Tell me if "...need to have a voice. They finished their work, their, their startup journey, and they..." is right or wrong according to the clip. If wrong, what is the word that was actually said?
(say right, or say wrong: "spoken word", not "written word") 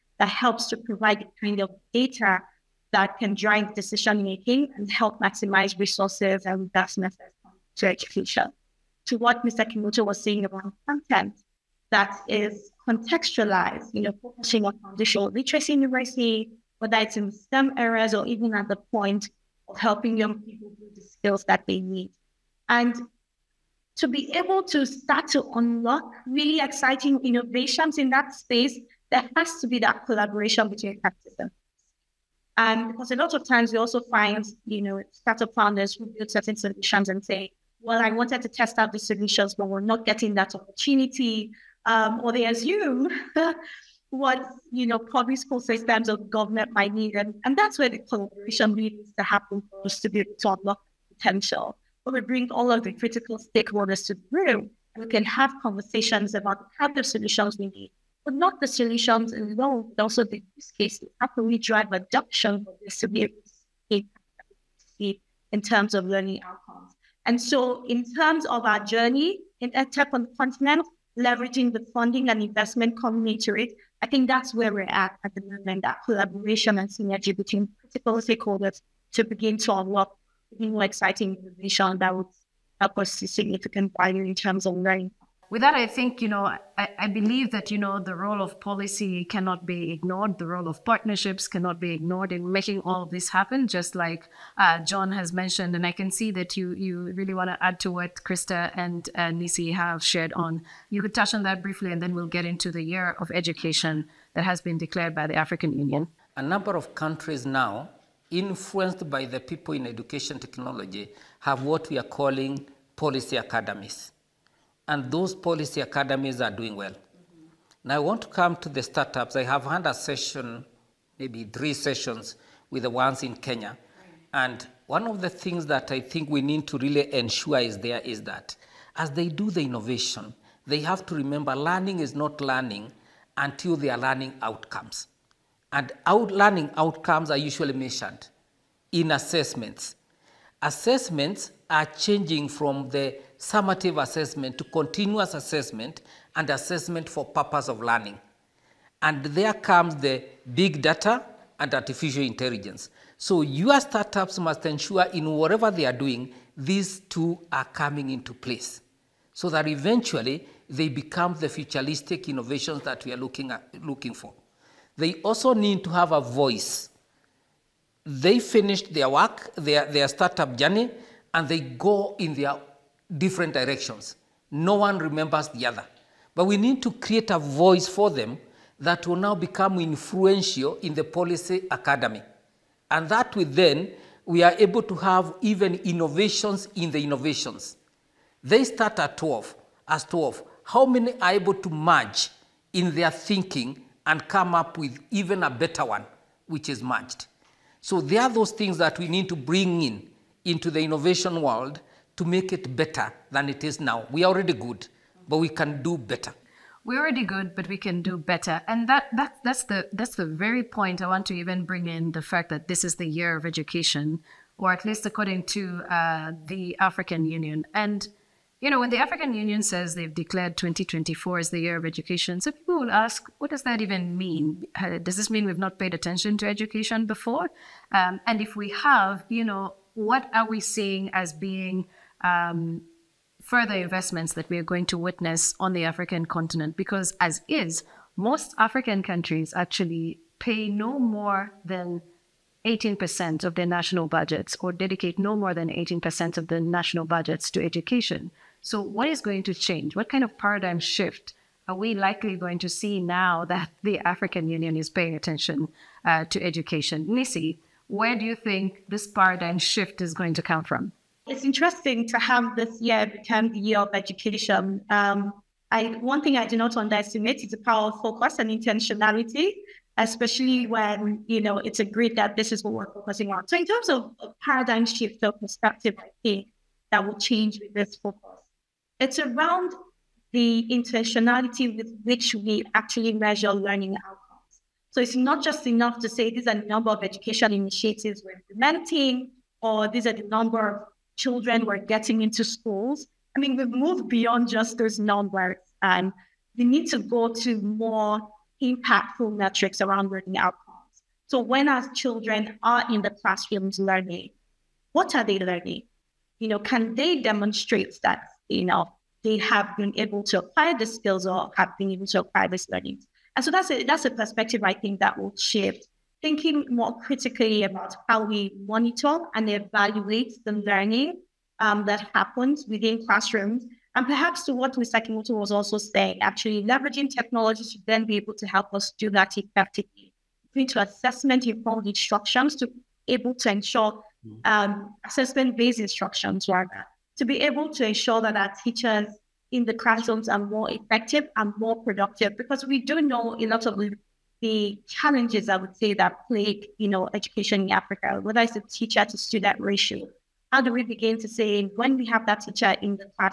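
right.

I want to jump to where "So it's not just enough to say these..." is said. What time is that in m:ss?
4:44.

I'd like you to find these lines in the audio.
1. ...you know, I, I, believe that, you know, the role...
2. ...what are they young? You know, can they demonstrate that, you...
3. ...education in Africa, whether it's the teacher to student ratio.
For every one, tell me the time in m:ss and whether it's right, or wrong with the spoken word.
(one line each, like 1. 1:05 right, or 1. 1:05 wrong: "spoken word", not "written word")
1. 1:26 right
2. 5:04 wrong: "learning", not "young"
3. 5:47 right.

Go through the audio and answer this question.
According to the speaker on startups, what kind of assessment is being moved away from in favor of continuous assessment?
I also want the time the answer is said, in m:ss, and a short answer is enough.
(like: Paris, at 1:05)
summative assessment, at 2:23.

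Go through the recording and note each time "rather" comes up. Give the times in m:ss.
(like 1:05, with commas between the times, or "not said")
5:36.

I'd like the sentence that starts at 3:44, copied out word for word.
Uh, does this mean we've not paid attention to education before?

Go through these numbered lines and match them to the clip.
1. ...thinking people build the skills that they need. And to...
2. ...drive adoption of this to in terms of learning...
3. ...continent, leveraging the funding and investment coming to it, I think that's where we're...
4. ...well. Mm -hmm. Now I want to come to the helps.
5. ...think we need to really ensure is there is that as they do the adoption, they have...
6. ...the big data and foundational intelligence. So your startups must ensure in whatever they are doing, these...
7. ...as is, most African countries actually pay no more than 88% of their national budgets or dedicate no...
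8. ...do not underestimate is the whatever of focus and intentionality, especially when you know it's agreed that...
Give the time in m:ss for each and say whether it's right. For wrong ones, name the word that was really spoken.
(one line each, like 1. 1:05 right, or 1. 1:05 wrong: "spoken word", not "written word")
1. 0:20 wrong: "young", not "thinking"
2. 1:01 right
3. 1:10 right
4. 1:56 wrong: "startups", not "helps"
5. 2:06 wrong: "innovation", not "adoption"
6. 2:29 wrong: "artificial", not "foundational"
7. 3:57 wrong: "18", not "88"
8. 4:26 wrong: "power", not "whatever".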